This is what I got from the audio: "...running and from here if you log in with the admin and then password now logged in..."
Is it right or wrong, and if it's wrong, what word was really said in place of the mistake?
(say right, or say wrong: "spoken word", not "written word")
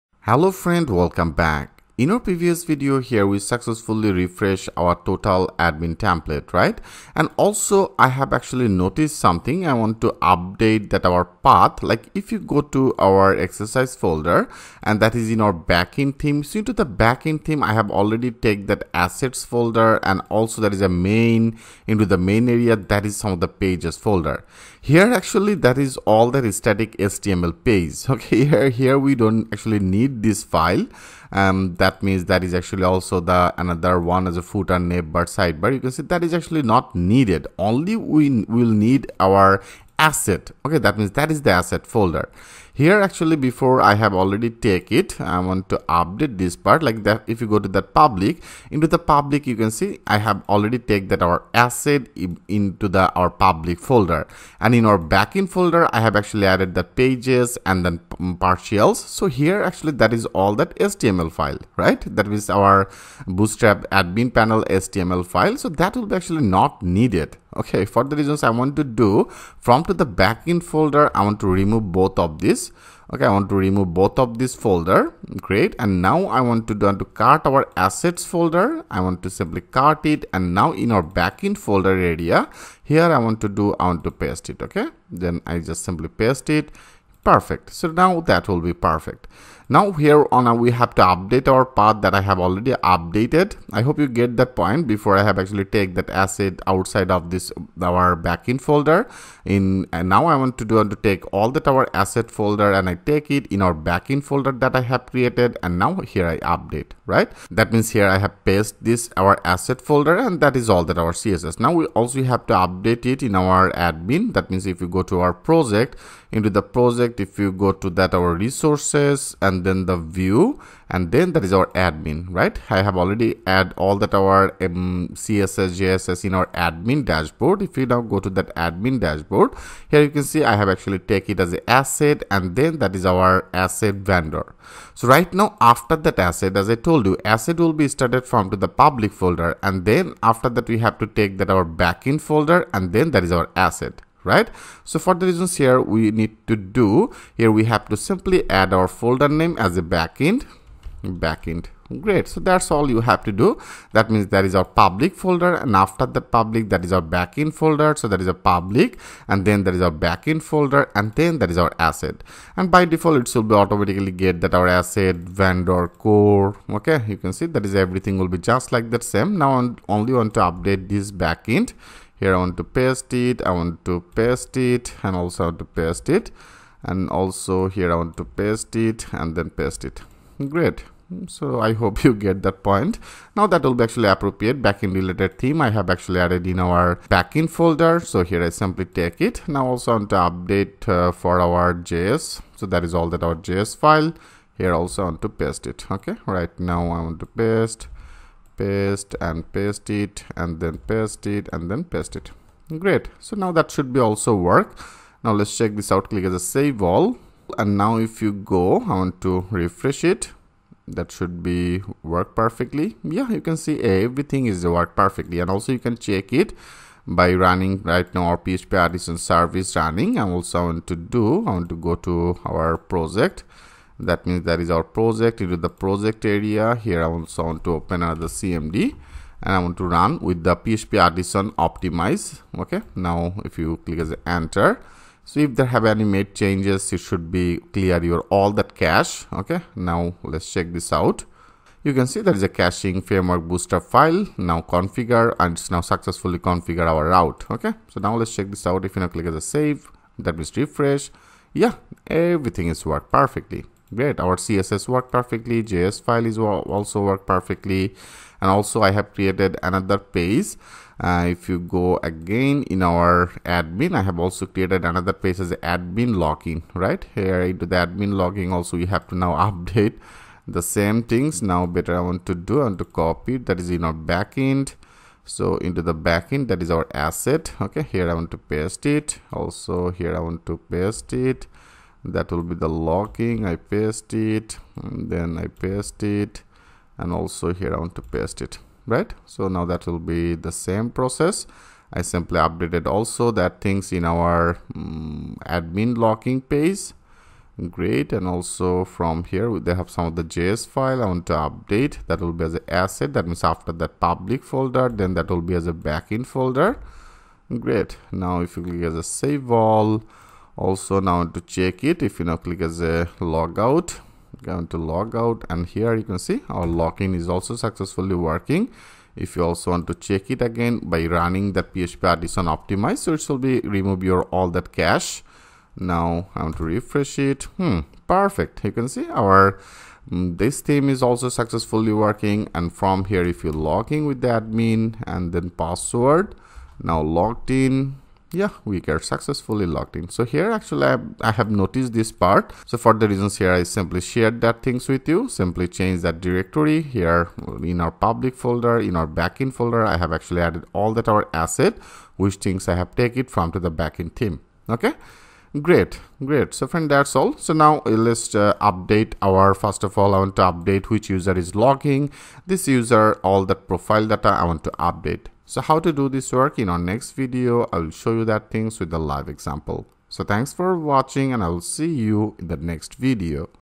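wrong: "working", not "running".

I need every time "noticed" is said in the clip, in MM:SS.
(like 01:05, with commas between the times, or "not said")
00:08, 05:41.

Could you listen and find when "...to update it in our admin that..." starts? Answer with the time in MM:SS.
01:52.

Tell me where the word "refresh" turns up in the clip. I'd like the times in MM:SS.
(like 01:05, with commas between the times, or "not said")
00:04, 03:29, 04:10, 05:26.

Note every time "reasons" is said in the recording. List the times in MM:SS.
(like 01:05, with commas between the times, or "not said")
01:08, 02:25, 05:43.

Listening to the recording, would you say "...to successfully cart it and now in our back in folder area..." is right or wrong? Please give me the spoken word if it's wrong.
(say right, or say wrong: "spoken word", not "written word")
wrong: "simply", not "successfully".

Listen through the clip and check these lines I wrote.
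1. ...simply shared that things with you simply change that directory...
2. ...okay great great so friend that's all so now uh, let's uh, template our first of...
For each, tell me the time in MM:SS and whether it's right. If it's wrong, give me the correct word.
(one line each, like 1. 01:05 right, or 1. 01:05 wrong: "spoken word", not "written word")
1. 05:43 right
2. 05:54 wrong: "update", not "template".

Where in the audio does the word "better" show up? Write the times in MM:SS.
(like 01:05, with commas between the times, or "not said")
04:31.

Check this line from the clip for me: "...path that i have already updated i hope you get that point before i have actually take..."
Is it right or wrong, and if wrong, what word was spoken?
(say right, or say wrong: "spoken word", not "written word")
right.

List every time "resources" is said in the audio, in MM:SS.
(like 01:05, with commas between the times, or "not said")
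01:58.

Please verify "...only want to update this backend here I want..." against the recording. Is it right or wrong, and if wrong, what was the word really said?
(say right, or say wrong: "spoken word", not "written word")
right.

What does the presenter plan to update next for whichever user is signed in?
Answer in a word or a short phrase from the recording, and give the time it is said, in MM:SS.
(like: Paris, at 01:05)
profile data, at 06:03.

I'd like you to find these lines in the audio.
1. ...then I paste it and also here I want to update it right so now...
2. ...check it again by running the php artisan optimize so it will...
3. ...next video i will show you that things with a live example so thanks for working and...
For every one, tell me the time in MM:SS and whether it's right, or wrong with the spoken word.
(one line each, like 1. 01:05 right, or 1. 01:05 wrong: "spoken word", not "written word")
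1. 04:44 wrong: "paste", not "update"
2. 05:19 right
3. 06:06 wrong: "watching", not "working".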